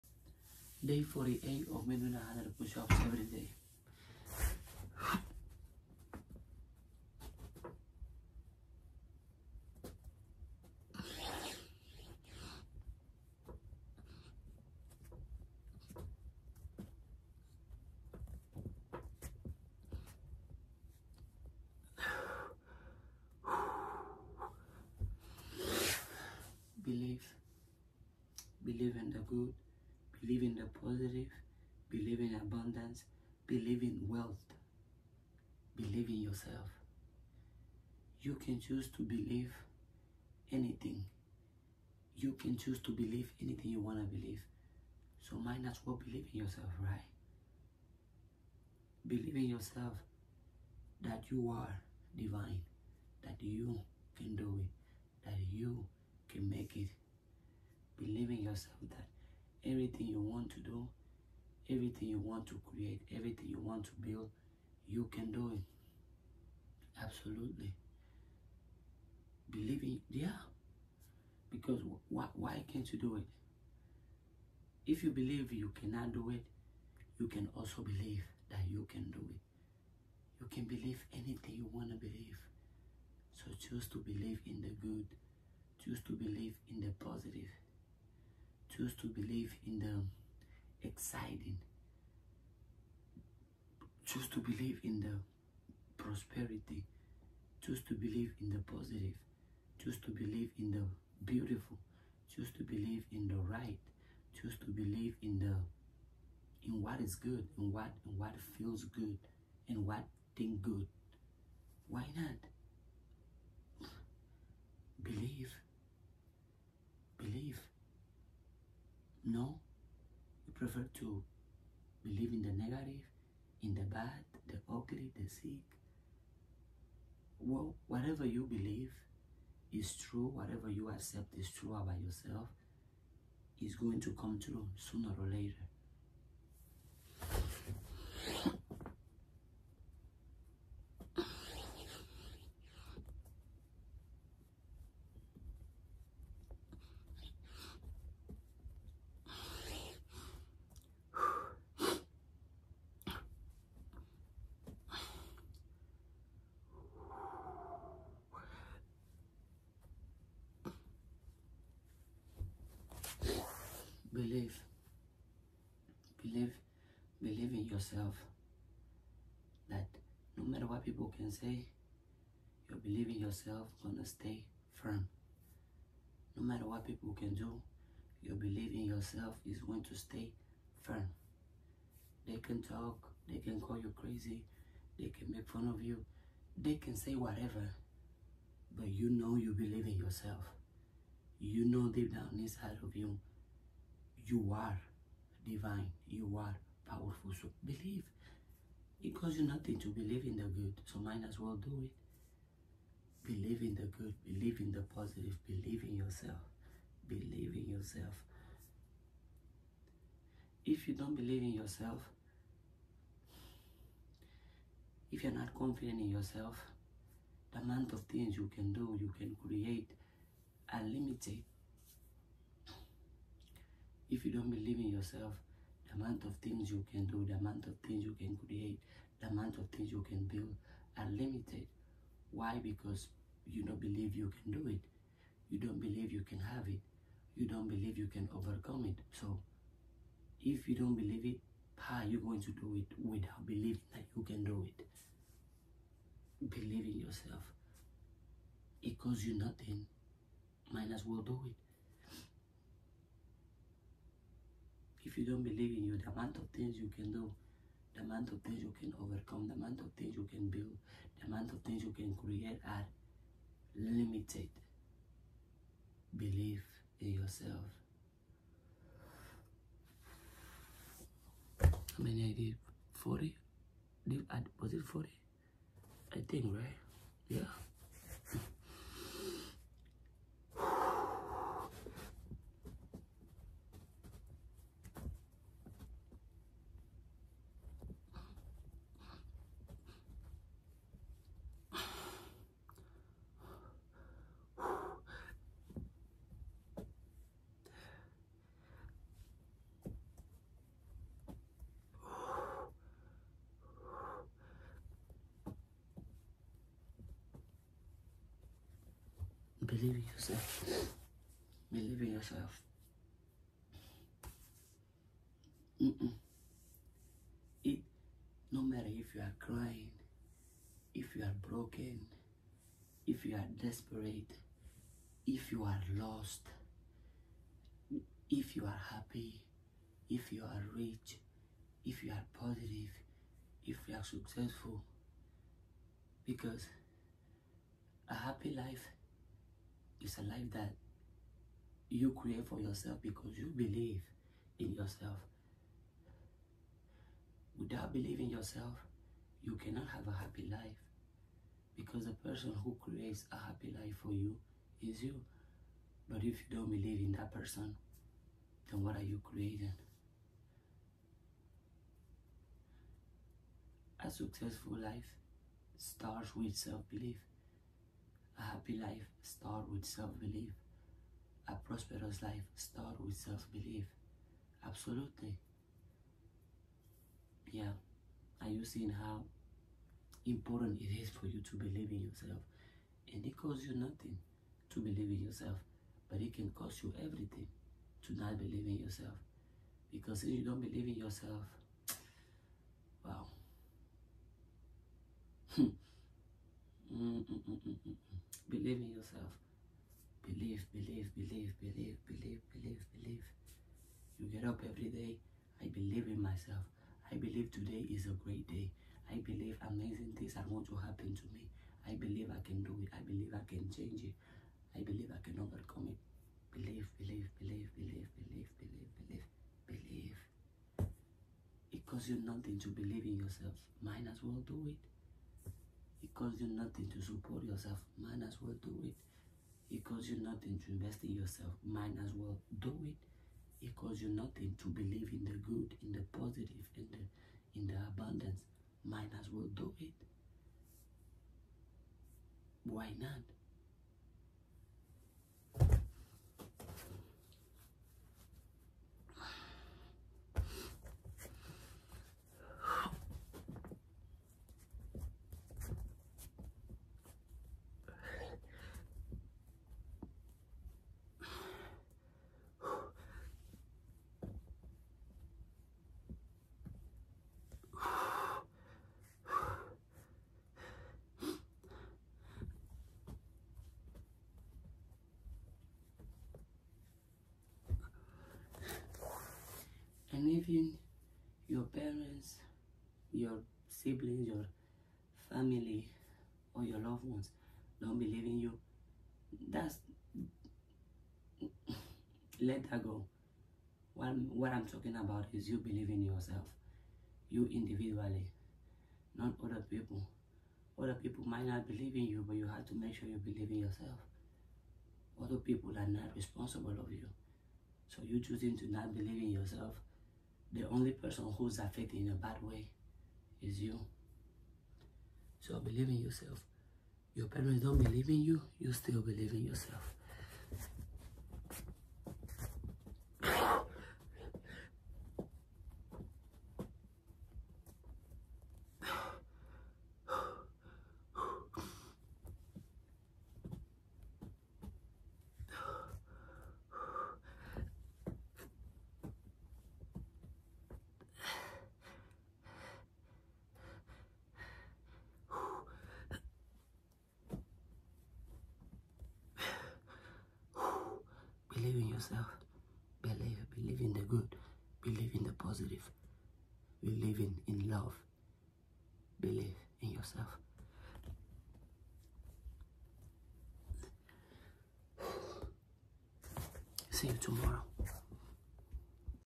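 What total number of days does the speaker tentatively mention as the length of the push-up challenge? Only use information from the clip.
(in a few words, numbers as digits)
100.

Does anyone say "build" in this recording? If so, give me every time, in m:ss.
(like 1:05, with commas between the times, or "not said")
1:04, 3:50, 4:20.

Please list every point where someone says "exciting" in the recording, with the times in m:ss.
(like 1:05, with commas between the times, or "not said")
1:30.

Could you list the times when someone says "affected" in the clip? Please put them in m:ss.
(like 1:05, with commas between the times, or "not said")
8:31.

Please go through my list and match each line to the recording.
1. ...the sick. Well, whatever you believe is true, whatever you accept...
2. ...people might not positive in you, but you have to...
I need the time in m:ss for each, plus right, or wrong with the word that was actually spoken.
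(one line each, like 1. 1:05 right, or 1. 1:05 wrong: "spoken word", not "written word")
1. 2:05 right
2. 8:20 wrong: "believe", not "positive".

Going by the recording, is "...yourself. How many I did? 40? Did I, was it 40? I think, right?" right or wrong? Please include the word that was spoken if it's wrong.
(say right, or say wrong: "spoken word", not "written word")
right.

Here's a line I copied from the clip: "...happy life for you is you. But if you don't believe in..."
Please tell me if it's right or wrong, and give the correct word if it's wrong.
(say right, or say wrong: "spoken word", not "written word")
right.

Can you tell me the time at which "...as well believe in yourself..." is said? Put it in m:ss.
0:45.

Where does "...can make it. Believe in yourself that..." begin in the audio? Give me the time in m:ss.
0:56.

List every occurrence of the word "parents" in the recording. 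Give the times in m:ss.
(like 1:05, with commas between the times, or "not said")
8:01, 8:37.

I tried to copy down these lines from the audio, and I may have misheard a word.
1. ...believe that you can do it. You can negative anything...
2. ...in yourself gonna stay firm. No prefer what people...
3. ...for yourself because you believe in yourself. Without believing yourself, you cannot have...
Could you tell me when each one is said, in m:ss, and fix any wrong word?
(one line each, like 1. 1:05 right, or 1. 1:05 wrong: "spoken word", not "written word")
1. 1:17 wrong: "believe", not "negative"
2. 2:53 wrong: "matter", not "prefer"
3. 5:42 right.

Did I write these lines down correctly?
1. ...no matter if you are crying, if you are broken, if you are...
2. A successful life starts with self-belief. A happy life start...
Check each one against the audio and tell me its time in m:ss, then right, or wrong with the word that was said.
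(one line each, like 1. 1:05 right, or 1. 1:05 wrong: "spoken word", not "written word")
1. 5:18 right
2. 6:04 right.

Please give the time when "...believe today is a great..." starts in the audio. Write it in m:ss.
6:47.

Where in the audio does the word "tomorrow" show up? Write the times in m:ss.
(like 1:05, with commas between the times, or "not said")
9:27.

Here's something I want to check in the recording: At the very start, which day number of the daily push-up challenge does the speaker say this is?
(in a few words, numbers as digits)
48.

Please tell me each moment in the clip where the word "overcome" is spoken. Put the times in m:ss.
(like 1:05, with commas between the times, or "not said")
3:58, 4:19, 6:55.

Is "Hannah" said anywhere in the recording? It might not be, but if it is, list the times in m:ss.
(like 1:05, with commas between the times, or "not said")
not said.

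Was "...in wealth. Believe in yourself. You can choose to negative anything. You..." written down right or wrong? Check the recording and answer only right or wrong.
wrong.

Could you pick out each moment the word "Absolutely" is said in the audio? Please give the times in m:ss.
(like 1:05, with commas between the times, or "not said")
1:07, 6:14.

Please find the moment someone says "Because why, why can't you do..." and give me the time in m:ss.
1:11.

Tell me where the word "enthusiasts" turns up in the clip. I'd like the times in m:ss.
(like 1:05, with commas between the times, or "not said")
not said.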